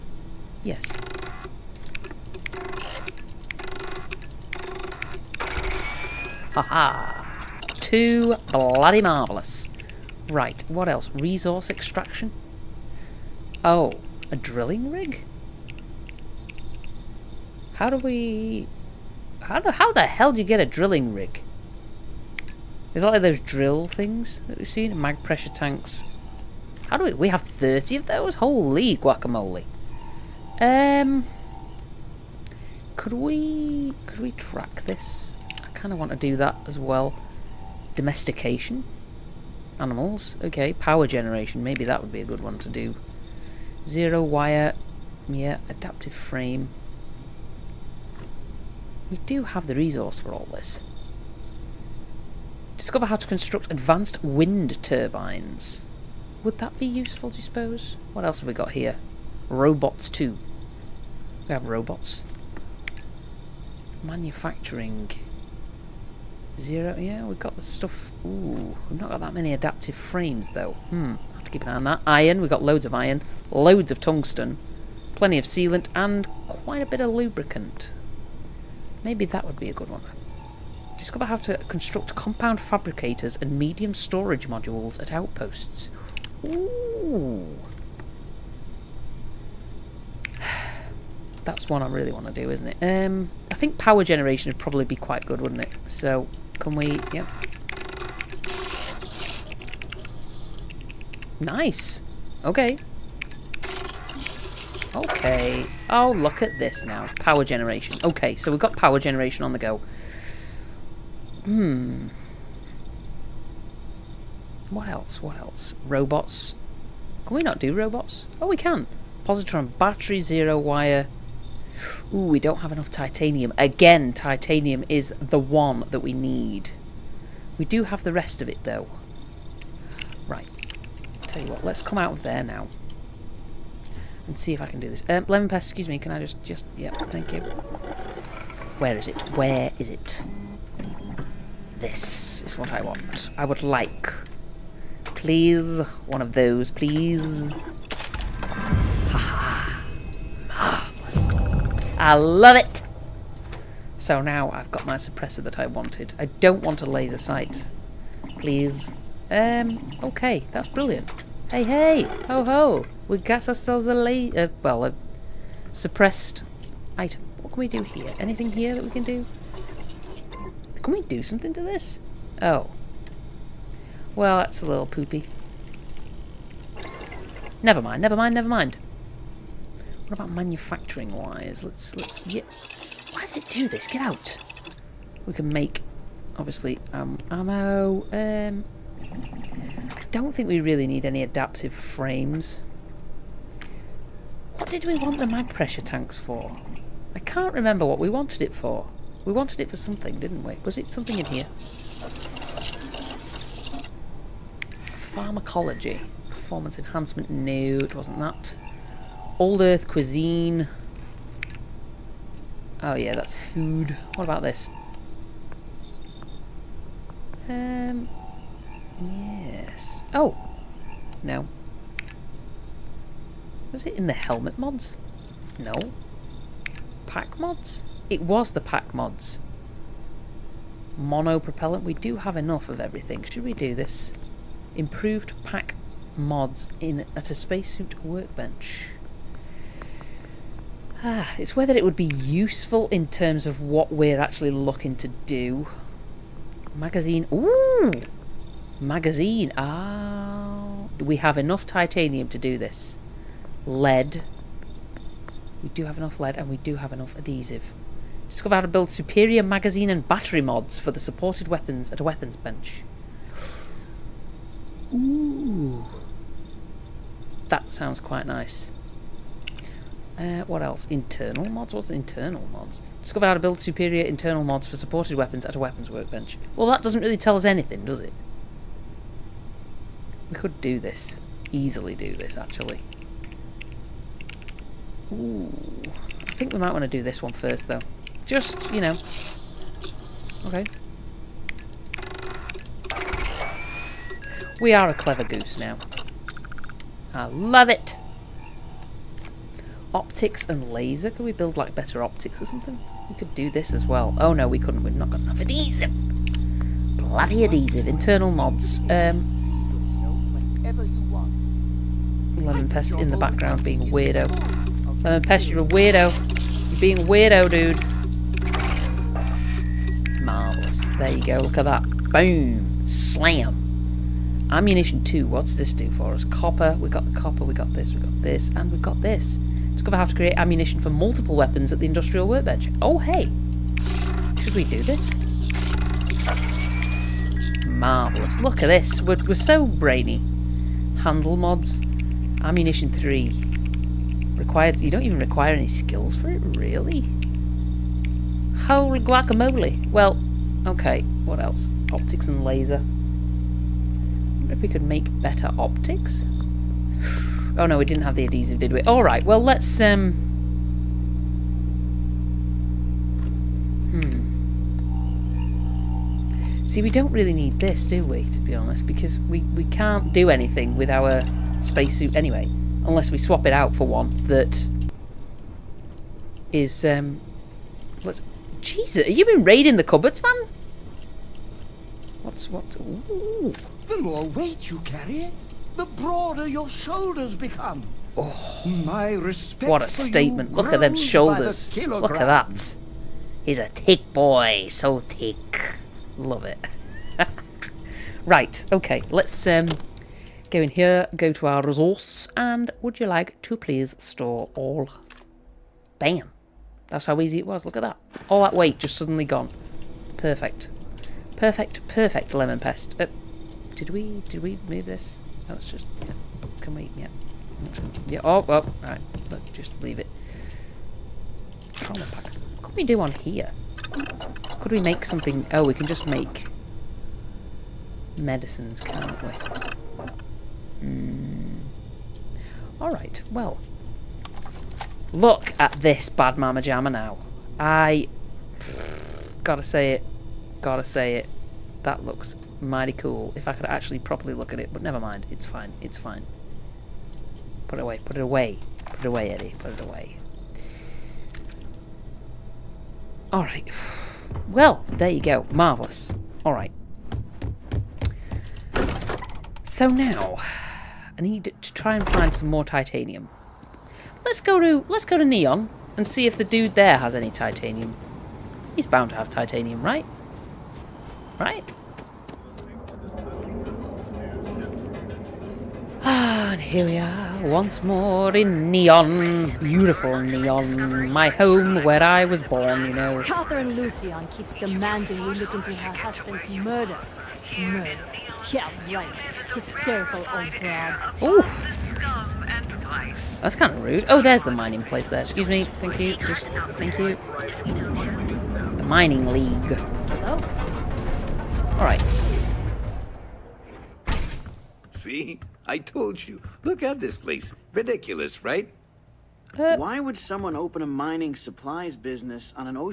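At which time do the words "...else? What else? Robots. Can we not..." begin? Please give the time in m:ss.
1:54.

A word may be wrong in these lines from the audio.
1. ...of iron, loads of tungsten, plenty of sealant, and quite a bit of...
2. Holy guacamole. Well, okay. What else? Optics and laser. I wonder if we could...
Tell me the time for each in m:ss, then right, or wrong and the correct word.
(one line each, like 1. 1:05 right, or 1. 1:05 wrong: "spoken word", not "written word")
1. 1:12 right
2. 5:48 right.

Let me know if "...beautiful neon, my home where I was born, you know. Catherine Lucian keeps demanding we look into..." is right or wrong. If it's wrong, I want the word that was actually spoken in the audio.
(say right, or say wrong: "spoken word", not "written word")
right.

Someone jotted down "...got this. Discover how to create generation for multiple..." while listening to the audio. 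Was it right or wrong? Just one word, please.
wrong.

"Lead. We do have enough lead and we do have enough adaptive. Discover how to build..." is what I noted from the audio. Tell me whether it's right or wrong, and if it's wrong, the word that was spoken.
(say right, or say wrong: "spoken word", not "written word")
wrong: "adhesive", not "adaptive".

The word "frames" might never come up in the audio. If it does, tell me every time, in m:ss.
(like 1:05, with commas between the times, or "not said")
0:46, 1:09, 3:11.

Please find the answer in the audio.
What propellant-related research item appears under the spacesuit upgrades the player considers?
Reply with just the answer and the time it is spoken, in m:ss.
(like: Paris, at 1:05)
Mono propellant, at 3:50.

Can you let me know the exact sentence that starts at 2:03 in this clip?
Again, titanium is the one that we need.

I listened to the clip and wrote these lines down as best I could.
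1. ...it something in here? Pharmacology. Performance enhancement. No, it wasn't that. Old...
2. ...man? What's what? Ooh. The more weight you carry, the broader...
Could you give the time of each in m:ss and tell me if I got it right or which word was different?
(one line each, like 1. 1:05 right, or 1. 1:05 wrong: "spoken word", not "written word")
1. 3:20 right
2. 6:20 right.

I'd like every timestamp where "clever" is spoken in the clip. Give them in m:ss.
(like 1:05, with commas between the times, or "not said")
4:54.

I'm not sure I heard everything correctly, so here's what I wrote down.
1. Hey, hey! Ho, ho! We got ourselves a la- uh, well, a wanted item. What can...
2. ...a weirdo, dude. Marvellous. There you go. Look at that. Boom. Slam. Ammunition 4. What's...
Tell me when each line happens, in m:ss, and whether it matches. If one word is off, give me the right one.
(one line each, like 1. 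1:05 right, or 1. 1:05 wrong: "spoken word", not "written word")
1. 2:41 wrong: "suppressed", not "wanted"
2. 5:17 wrong: "2", not "4".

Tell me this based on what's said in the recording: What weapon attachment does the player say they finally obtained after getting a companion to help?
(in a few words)
suppressor.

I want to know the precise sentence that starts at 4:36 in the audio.
Well, that doesn't really tell us anything, does it?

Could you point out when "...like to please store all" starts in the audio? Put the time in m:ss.
6:43.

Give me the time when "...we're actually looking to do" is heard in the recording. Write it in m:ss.
4:03.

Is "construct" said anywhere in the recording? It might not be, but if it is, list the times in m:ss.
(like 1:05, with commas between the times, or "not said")
0:53, 1:21.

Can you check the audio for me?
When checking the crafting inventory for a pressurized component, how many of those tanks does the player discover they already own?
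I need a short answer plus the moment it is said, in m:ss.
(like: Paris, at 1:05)
30, at 0:27.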